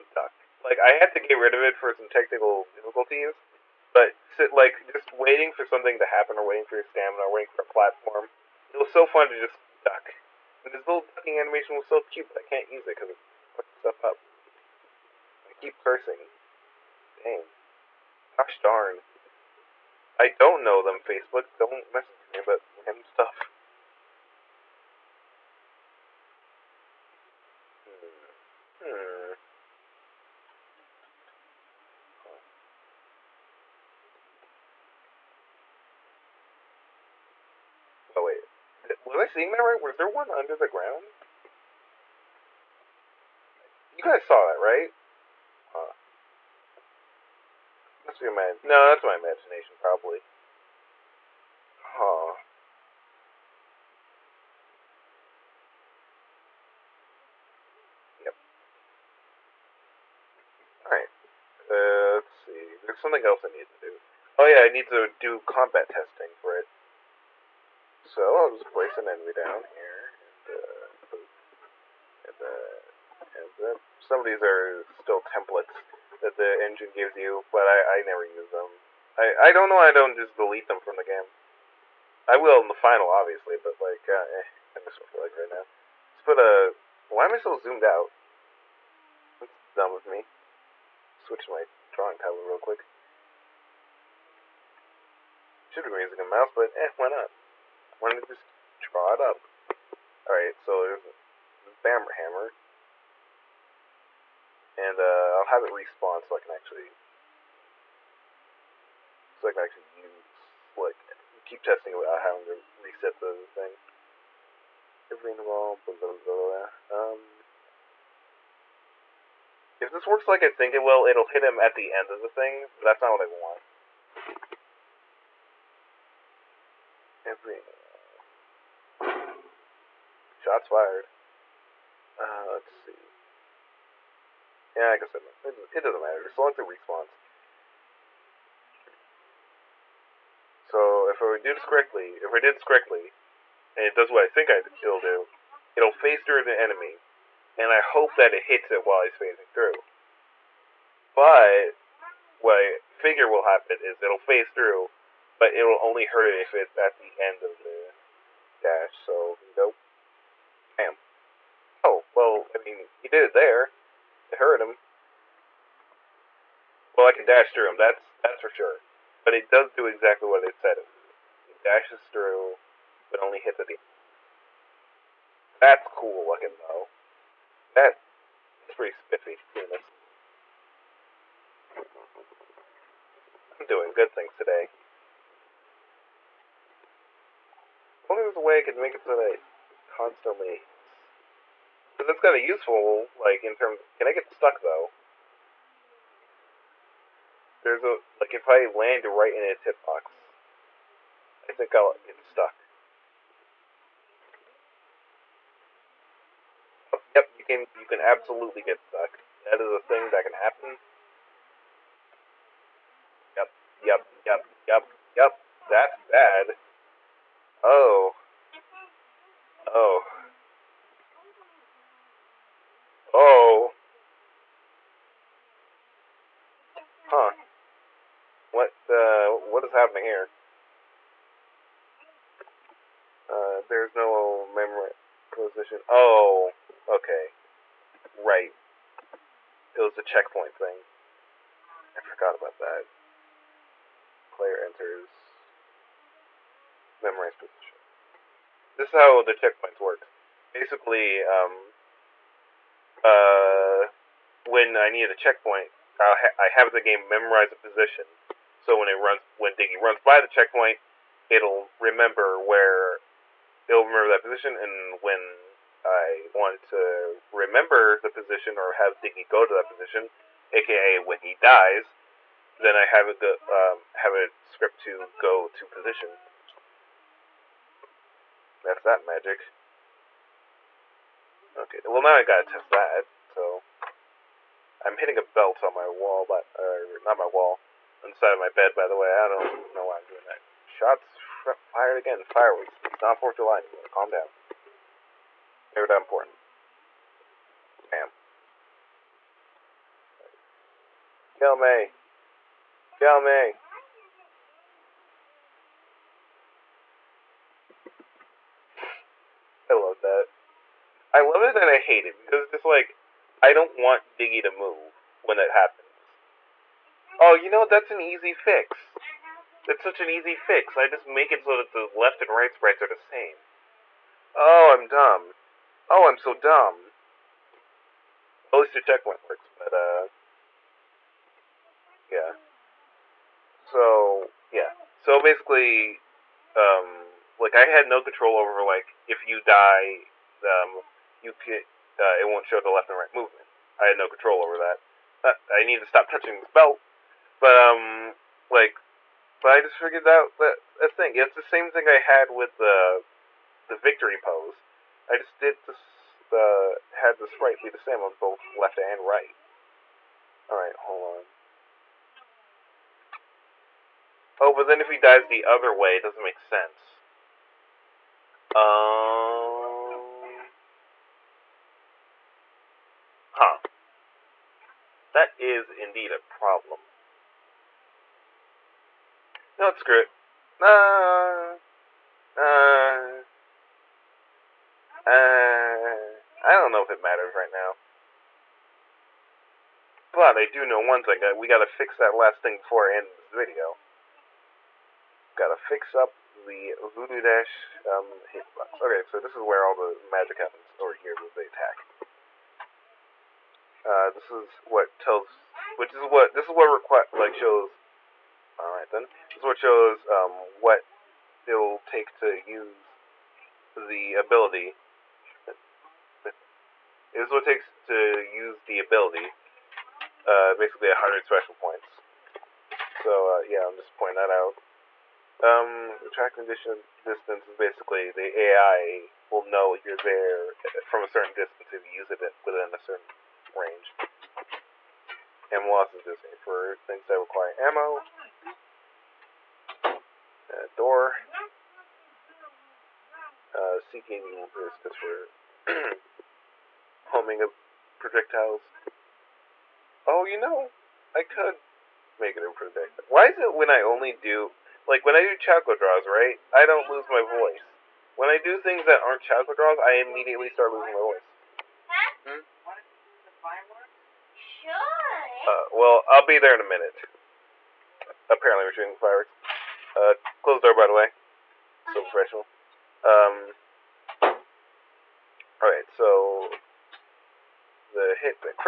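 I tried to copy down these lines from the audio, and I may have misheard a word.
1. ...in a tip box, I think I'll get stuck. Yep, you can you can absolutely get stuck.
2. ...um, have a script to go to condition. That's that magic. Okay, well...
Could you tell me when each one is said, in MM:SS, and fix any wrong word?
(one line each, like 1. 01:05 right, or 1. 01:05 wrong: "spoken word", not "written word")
1. 03:19 right
2. 04:33 wrong: "position", not "condition".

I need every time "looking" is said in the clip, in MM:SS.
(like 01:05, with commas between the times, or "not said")
02:56.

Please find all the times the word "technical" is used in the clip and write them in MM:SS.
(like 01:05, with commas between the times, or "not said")
00:02.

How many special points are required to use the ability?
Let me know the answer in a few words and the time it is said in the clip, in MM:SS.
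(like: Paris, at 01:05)
100, at 07:00.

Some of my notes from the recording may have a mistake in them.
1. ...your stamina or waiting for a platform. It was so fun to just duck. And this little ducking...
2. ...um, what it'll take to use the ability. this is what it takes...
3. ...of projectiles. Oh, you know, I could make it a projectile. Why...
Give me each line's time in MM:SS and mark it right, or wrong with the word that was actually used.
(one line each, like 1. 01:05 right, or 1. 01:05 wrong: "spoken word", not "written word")
1. 00:06 right
2. 06:50 right
3. 07:27 right.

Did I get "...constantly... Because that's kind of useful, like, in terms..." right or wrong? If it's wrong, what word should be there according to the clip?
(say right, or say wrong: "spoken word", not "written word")
right.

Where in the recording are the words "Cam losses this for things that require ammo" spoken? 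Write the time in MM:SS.
07:15.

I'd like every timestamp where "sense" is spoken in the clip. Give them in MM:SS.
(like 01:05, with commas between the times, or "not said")
06:06.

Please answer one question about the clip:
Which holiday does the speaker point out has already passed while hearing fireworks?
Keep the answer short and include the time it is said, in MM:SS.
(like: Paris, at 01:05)
4th of July, at 04:53.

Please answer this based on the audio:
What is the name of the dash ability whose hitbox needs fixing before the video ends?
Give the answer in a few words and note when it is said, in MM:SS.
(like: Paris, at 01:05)
Voodoo Dash, at 06:36.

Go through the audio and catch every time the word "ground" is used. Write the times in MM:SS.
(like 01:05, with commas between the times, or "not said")
00:40.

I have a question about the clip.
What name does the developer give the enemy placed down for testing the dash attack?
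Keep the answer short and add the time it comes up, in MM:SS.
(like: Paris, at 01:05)
Bammer Hammer, at 01:41.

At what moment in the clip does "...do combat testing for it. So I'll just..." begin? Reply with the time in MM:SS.
01:05.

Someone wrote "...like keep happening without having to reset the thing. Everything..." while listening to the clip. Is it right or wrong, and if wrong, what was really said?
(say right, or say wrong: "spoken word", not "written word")
wrong: "testing", not "happening".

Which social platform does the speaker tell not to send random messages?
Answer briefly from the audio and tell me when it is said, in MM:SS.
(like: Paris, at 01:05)
Facebook, at 00:21.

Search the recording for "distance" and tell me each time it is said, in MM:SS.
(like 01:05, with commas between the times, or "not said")
07:07, 07:11.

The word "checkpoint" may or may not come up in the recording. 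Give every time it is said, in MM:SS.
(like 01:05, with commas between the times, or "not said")
04:00, 04:09, 04:15, 04:20, 05:28.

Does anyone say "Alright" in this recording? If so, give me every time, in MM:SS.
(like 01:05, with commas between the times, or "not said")
01:40, 06:00, 06:48.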